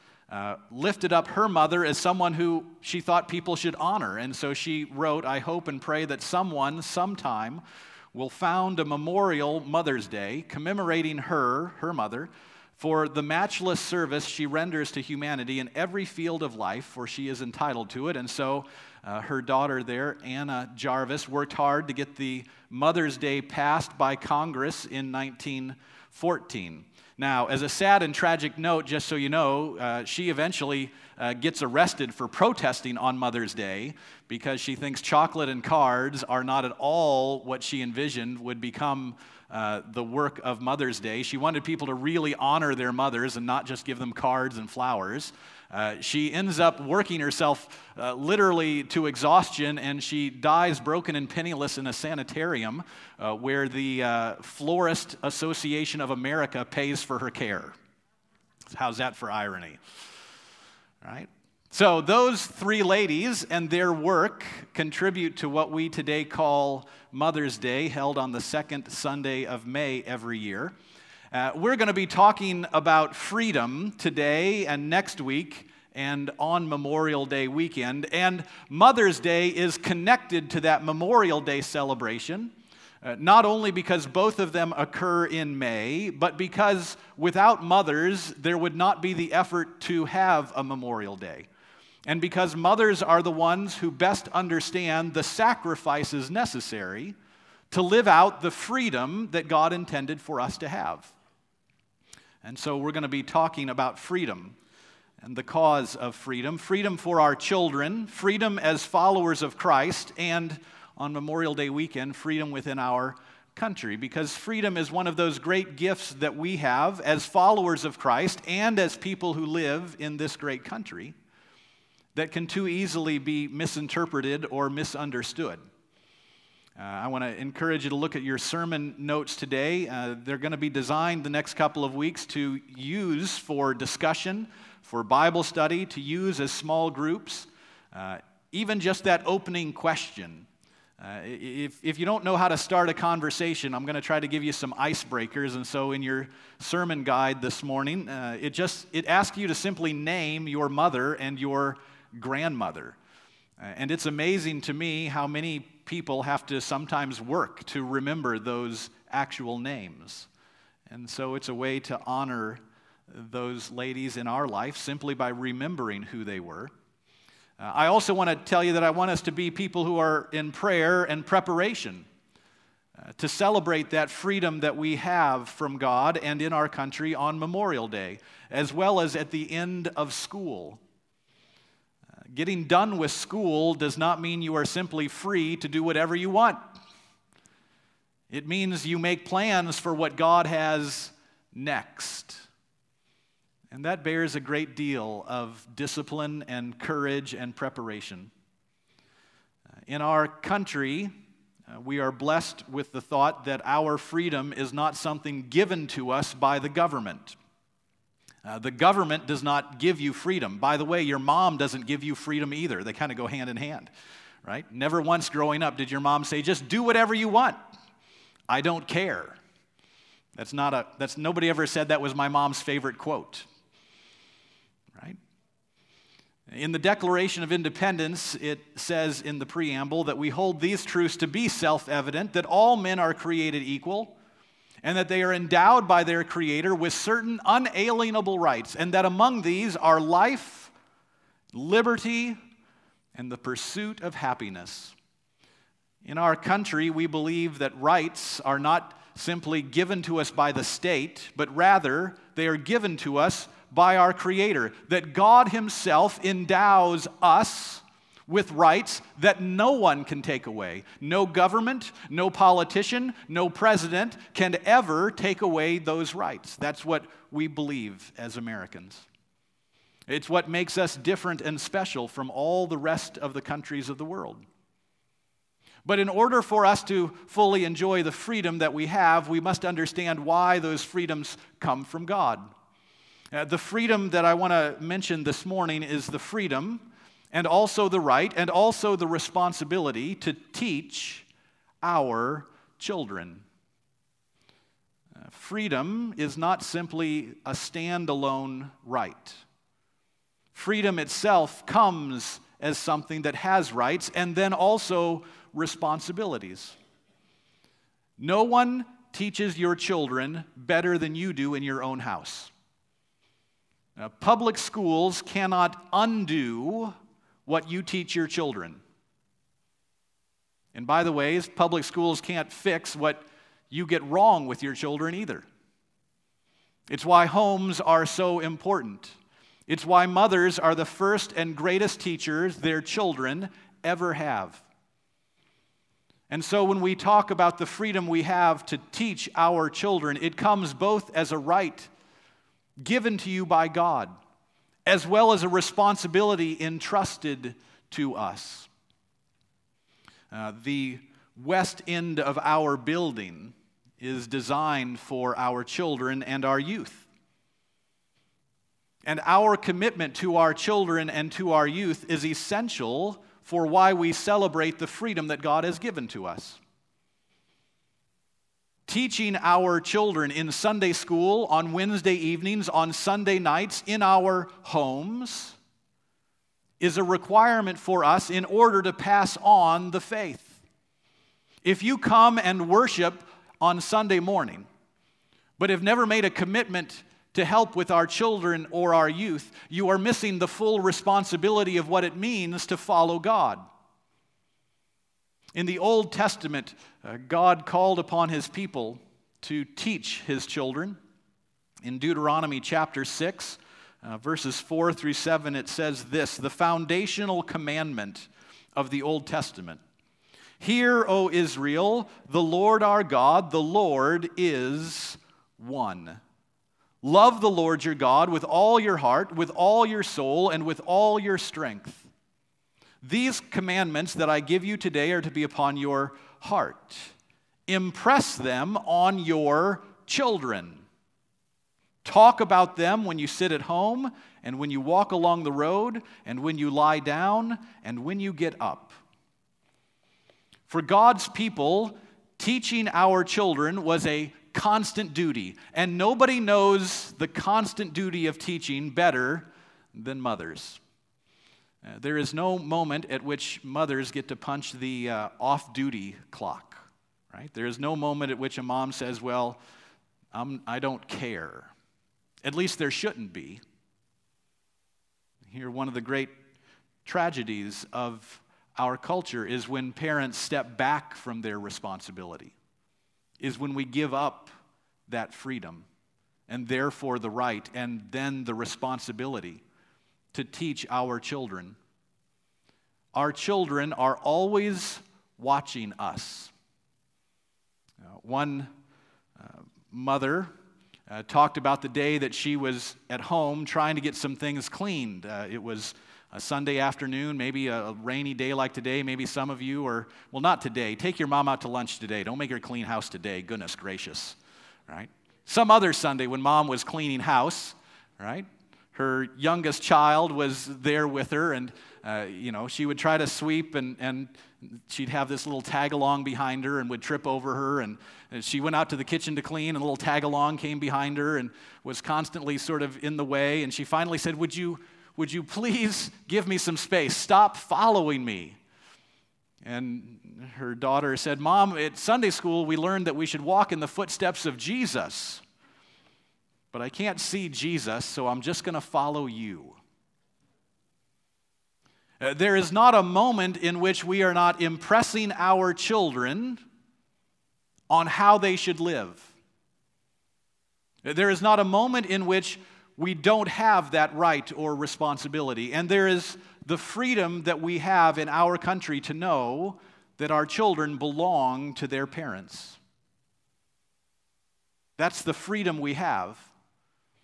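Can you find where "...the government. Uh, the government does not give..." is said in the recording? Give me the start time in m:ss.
3:26.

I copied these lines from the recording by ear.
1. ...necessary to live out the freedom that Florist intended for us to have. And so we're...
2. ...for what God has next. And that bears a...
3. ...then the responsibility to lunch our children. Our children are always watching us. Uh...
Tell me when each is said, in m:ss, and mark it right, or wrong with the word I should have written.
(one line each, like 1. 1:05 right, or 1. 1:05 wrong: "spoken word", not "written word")
1. 1:36 wrong: "God", not "Florist"
2. 3:09 right
3. 7:58 wrong: "teach", not "lunch".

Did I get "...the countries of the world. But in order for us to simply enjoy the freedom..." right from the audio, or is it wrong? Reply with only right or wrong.
wrong.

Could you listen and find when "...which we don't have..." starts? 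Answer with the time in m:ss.
9:12.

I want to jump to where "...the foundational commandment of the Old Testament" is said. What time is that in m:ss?
6:46.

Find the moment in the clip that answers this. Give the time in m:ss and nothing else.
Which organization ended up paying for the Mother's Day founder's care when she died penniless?
0:54.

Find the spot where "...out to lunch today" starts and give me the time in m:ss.
8:21.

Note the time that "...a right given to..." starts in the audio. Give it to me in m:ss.
5:41.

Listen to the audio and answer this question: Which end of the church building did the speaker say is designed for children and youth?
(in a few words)
West end.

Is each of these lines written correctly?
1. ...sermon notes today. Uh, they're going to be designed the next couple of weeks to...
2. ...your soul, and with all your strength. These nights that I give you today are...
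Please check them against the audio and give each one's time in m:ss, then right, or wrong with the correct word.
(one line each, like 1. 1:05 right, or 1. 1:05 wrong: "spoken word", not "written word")
1. 2:08 right
2. 6:59 wrong: "commandments", not "nights".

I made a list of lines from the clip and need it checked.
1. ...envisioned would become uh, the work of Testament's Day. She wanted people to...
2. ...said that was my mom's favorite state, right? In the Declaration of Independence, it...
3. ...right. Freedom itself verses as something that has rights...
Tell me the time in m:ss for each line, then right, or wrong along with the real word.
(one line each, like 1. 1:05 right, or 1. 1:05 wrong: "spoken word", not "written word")
1. 0:37 wrong: "Mother", not "Testament"
2. 3:41 wrong: "quote", not "state"
3. 4:58 wrong: "comes", not "verses".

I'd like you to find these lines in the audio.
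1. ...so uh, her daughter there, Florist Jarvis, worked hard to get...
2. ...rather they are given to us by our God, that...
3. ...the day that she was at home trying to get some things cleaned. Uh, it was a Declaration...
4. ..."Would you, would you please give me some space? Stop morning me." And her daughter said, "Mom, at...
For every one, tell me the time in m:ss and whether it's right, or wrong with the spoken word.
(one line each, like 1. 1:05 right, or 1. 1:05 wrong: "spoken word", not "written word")
1. 0:18 wrong: "Anna", not "Florist"
2. 4:11 wrong: "Creator", not "God"
3. 8:11 wrong: "Sunday", not "Declaration"
4. 8:44 wrong: "following", not "morning".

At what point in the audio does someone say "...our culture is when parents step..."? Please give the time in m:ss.
7:48.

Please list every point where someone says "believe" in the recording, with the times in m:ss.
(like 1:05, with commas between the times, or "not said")
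4:07, 4:27.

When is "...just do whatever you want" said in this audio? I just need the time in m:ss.
3:36.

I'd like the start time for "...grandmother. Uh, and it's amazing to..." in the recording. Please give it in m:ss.
2:32.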